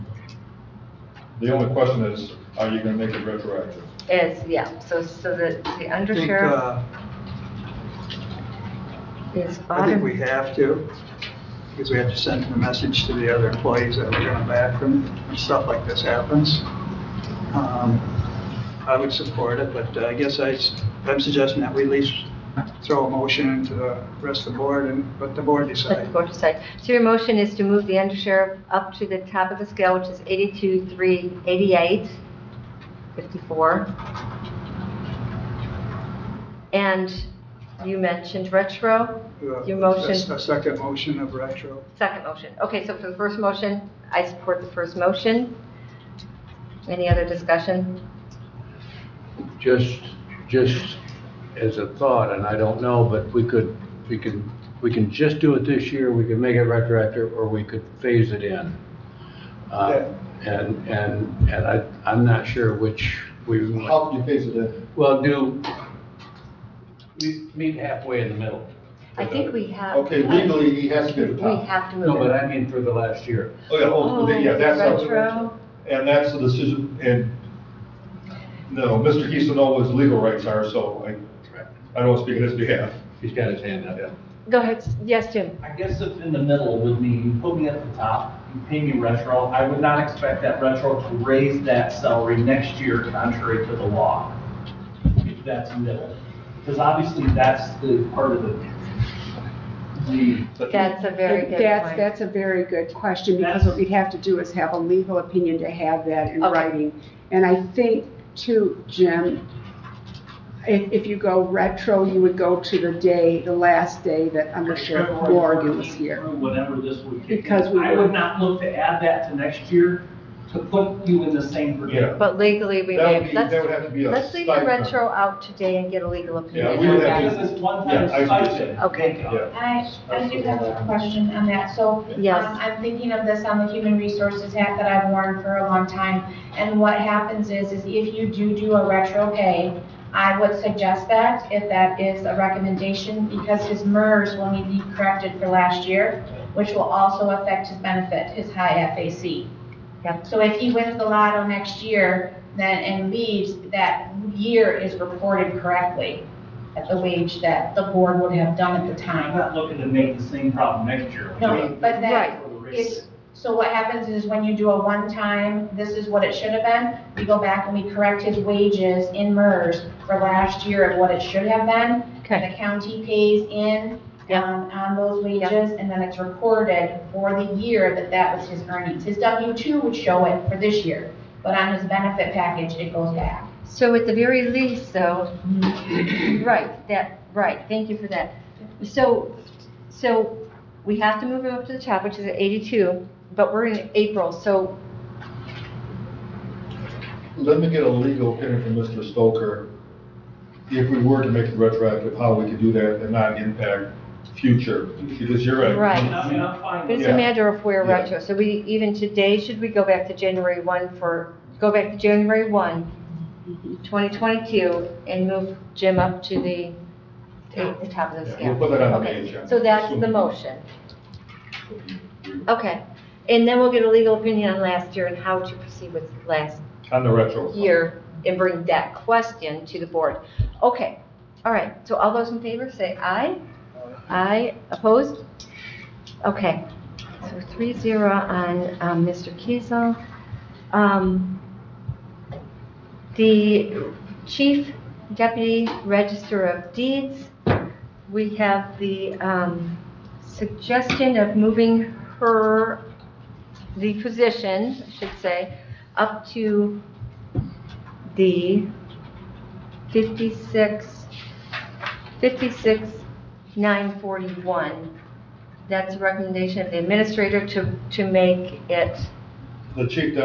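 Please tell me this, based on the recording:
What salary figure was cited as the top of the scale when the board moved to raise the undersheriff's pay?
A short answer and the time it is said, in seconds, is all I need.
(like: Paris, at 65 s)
82,388, at 30 s.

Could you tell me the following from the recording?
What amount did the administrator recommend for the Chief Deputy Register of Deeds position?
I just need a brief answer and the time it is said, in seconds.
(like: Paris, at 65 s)
56,941, at 262 s.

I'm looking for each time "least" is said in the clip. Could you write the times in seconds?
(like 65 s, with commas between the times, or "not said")
21 s, 184 s.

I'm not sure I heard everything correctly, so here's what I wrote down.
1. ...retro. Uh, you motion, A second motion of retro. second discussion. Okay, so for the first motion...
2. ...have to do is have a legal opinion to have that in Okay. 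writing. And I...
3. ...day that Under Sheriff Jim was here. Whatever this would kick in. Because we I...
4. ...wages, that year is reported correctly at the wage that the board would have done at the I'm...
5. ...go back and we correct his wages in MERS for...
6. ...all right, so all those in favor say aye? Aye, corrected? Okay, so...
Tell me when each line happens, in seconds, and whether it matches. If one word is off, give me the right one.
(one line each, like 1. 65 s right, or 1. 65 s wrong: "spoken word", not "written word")
1. 38 s wrong: "motion", not "discussion"
2. 103 s right
3. 114 s wrong: "Morgan", not "Jim"
4. 153 s wrong: "leaves", not "wages"
5. 167 s right
6. 231 s wrong: "opposed", not "corrected".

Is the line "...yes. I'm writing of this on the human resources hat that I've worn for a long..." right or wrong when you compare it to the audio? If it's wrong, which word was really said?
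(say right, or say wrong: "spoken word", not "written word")
wrong: "thinking", not "writing".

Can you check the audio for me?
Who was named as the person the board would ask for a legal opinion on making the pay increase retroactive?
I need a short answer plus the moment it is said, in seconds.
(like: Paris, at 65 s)
Mr. Stoker, at 198 s.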